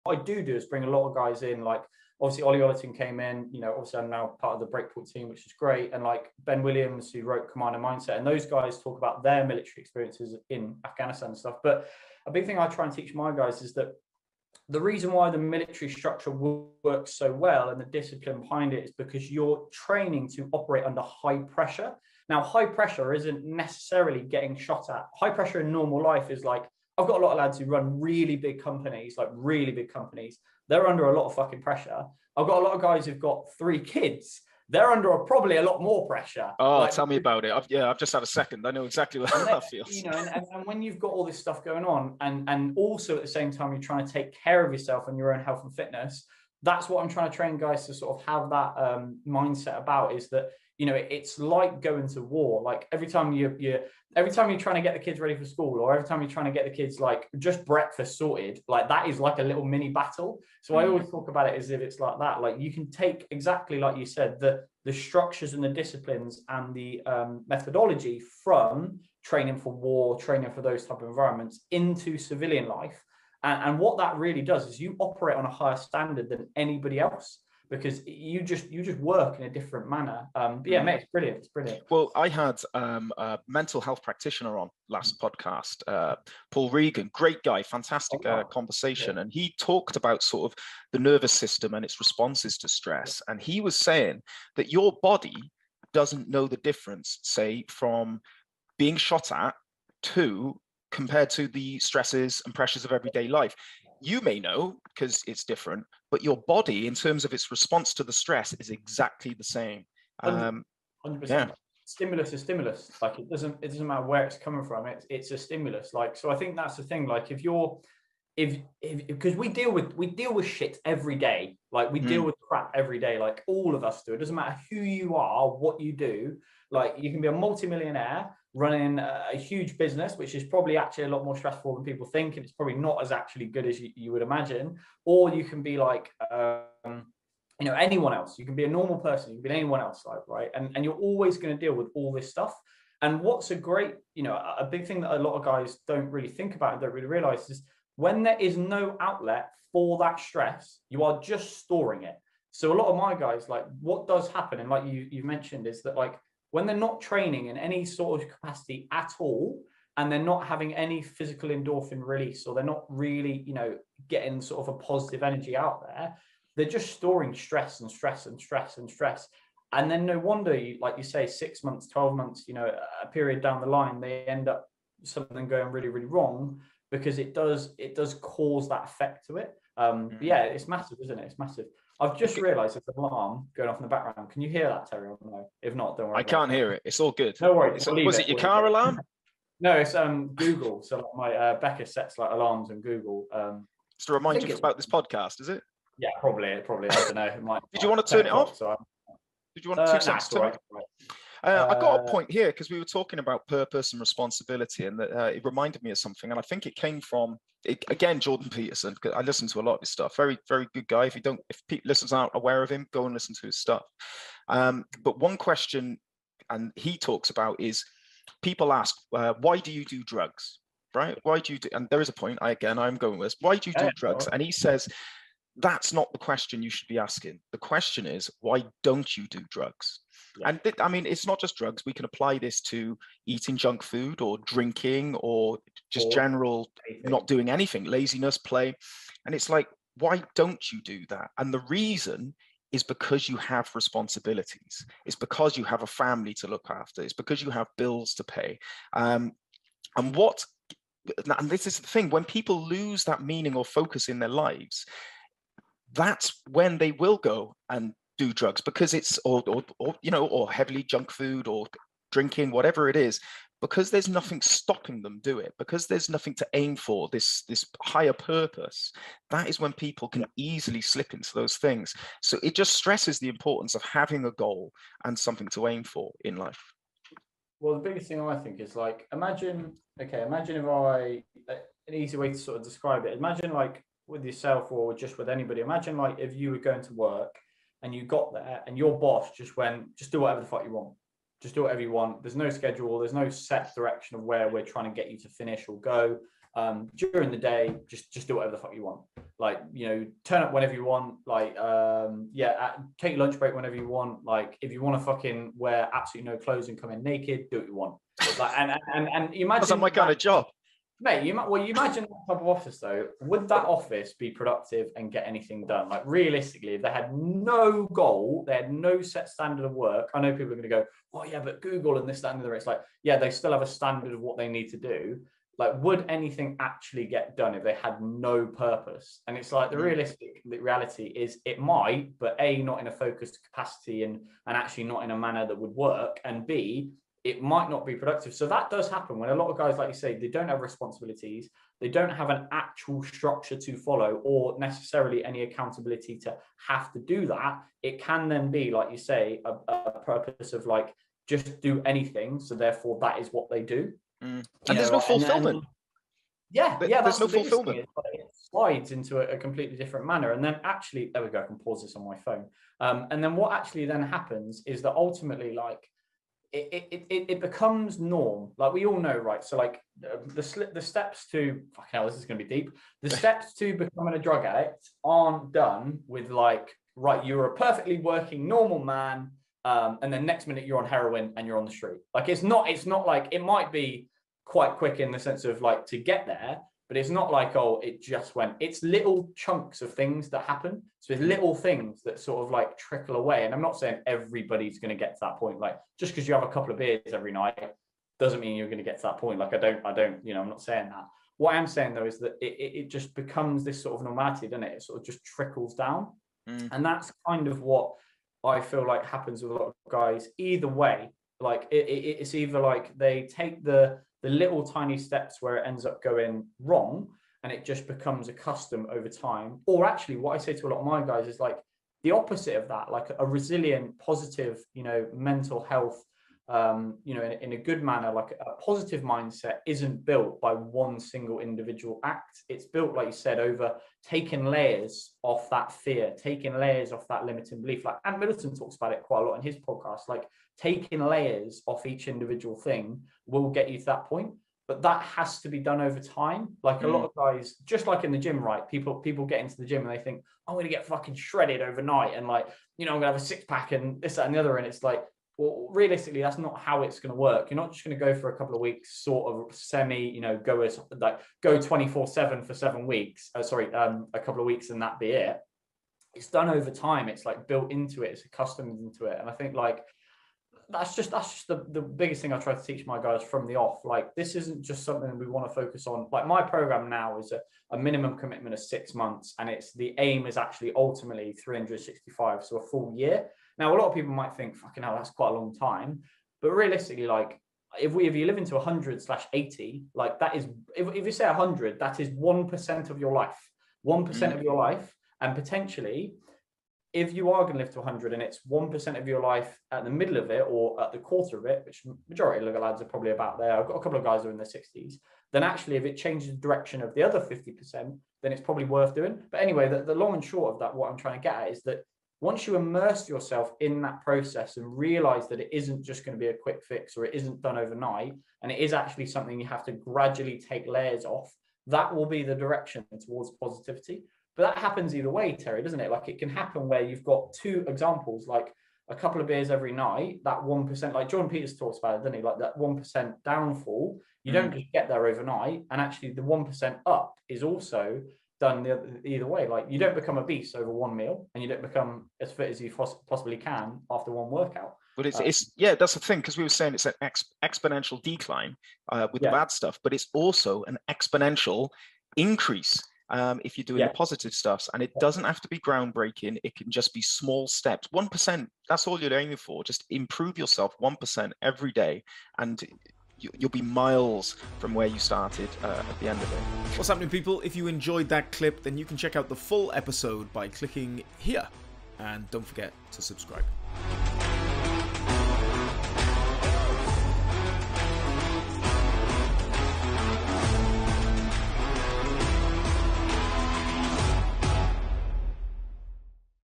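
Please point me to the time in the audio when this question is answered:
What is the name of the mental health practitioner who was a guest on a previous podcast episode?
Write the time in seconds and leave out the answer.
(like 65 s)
86 s.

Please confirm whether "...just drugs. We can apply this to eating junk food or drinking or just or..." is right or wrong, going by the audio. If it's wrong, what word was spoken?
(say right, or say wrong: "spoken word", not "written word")
right.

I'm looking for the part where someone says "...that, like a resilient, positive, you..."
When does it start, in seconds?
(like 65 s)
422 s.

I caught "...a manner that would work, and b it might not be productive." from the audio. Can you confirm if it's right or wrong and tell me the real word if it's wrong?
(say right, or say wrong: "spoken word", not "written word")
right.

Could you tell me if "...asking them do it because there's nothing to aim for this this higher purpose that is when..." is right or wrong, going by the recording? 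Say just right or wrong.
wrong.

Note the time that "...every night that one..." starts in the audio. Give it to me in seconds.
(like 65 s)
529 s.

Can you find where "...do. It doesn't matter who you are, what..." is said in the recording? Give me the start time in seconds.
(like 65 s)
124 s.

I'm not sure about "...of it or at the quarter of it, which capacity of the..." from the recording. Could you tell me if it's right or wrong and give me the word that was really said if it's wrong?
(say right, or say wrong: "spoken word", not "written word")
wrong: "majority", not "capacity".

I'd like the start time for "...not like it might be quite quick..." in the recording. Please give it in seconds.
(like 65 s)
382 s.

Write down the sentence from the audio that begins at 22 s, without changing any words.
Now, high pressure isn't necessarily getting shot at.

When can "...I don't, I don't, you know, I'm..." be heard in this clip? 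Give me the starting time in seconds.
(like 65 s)
399 s.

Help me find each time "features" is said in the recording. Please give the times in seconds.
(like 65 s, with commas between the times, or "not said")
not said.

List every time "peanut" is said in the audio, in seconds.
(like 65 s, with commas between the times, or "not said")
not said.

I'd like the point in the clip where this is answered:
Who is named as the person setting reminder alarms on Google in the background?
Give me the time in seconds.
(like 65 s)
191 s.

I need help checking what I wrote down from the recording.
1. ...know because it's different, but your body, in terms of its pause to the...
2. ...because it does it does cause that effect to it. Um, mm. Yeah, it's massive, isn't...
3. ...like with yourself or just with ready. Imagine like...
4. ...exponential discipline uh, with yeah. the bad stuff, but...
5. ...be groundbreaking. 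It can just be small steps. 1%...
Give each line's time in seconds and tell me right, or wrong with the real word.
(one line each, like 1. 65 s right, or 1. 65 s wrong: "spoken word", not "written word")
1. 104 s wrong: "response", not "pause"
2. 176 s right
3. 283 s wrong: "anybody", not "ready"
4. 547 s wrong: "decline", not "discipline"
5. 555 s right.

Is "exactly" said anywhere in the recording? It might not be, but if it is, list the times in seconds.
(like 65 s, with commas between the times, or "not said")
38 s, 63 s, 108 s.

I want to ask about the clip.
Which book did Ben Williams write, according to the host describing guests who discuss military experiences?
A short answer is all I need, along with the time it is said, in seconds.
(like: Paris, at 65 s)
Commando Mindset, at 7 s.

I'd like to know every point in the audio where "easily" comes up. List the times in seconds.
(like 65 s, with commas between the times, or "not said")
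270 s.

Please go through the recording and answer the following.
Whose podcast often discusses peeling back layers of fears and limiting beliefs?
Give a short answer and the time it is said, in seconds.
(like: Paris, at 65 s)
Ant Middleton, at 438 s.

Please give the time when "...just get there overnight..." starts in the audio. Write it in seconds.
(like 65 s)
534 s.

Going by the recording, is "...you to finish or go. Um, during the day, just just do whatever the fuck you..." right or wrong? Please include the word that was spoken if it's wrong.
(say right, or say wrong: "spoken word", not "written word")
right.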